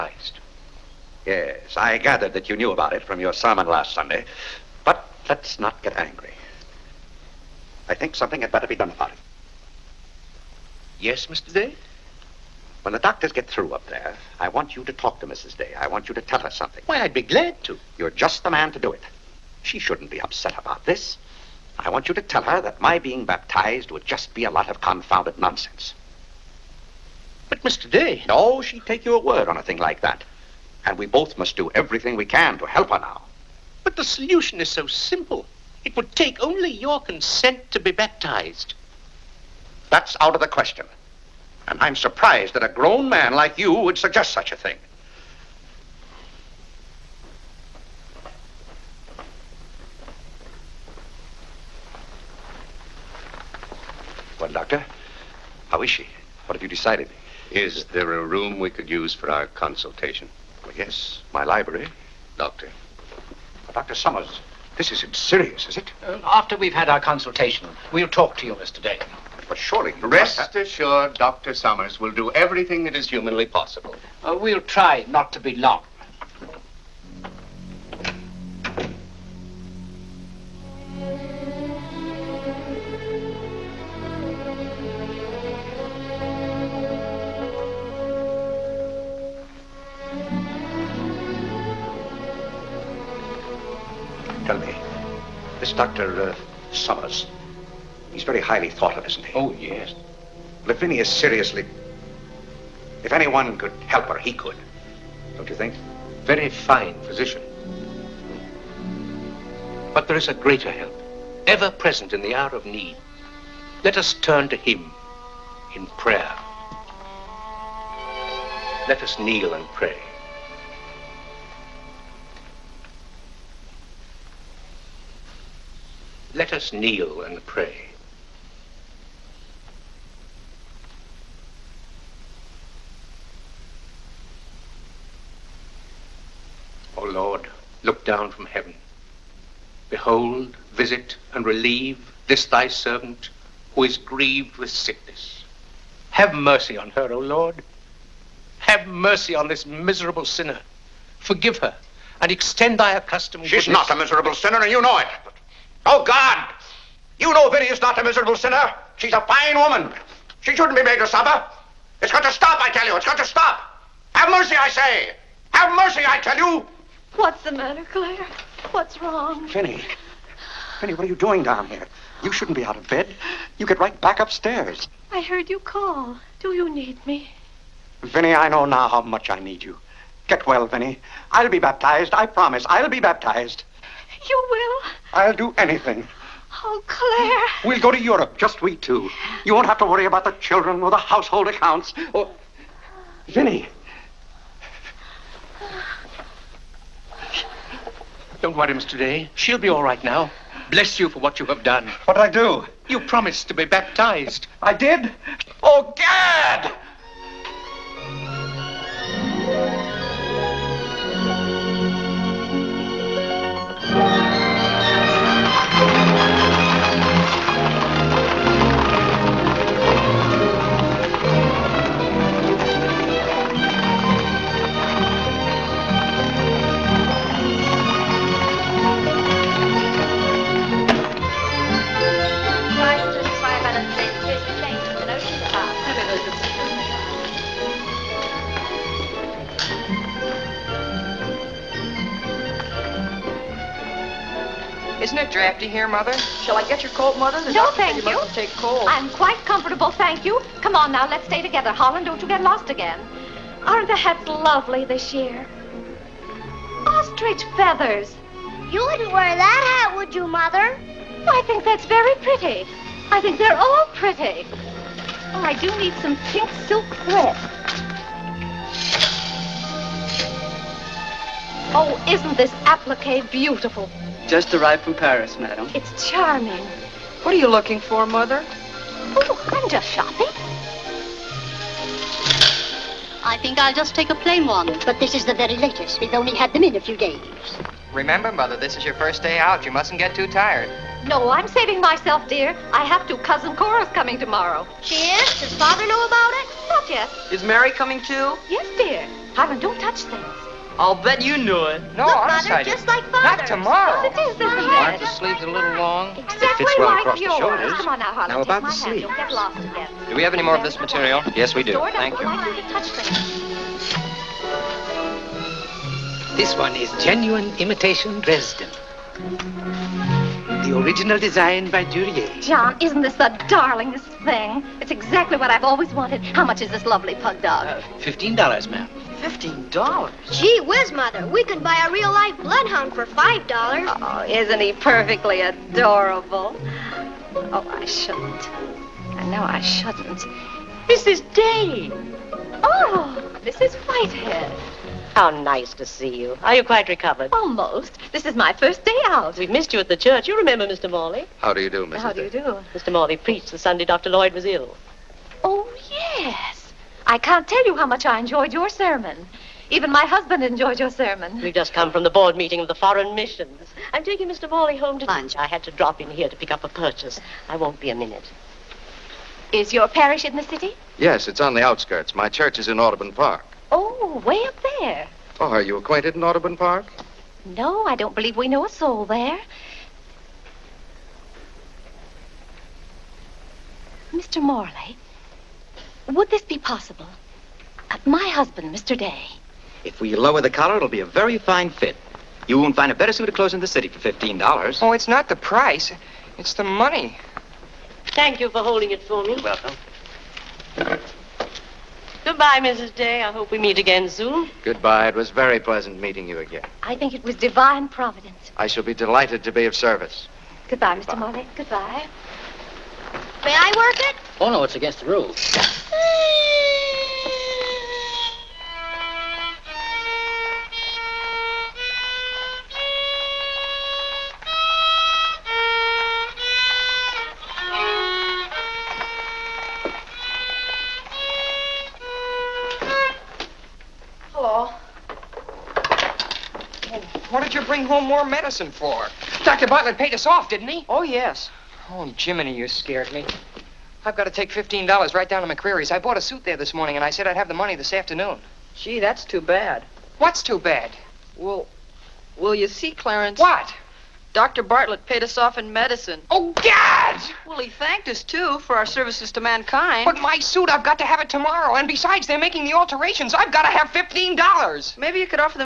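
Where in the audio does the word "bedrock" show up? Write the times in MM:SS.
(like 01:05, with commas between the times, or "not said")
not said.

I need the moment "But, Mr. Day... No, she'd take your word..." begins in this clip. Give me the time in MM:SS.
00:27.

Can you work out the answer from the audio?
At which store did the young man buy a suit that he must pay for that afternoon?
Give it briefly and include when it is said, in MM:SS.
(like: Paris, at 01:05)
McCreery's, at 07:25.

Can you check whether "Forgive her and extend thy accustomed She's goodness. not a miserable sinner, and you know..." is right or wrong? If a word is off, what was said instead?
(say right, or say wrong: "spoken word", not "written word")
right.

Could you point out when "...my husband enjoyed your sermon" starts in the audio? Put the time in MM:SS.
05:59.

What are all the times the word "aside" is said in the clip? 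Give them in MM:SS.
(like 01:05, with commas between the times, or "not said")
not said.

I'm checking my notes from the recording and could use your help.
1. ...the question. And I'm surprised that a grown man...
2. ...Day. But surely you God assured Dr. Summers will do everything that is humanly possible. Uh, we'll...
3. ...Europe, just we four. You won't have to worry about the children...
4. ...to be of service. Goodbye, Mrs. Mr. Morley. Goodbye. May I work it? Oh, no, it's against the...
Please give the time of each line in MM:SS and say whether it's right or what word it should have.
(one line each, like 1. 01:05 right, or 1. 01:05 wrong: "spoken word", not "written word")
1. 00:40 right
2. 01:08 wrong: "Rest", not "God"
3. 03:07 wrong: "two", not "four"
4. 06:49 wrong: "Goodbye", not "Mrs".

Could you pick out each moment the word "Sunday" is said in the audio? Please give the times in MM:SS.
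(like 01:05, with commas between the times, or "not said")
00:03, 05:53.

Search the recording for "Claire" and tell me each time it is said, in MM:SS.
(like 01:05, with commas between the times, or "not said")
02:47, 03:06.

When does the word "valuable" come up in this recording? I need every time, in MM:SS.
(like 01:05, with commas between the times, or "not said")
not said.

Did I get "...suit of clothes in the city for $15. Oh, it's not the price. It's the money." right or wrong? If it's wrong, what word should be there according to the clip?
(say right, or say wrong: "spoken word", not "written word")
right.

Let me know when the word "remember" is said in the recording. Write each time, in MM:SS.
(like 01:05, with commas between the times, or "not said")
04:47, 05:50.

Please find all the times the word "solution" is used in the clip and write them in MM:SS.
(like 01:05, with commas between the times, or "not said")
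00:34.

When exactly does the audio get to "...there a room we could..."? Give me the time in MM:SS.
00:57.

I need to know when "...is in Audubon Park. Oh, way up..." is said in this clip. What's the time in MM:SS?
06:12.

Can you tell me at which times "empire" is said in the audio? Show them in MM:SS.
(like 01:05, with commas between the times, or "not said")
not said.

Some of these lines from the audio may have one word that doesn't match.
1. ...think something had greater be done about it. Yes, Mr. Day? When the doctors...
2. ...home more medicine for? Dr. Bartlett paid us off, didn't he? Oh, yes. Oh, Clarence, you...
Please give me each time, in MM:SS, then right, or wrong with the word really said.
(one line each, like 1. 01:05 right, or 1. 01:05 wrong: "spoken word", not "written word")
1. 00:07 wrong: "better", not "greater"
2. 07:17 wrong: "Jiminy", not "Clarence".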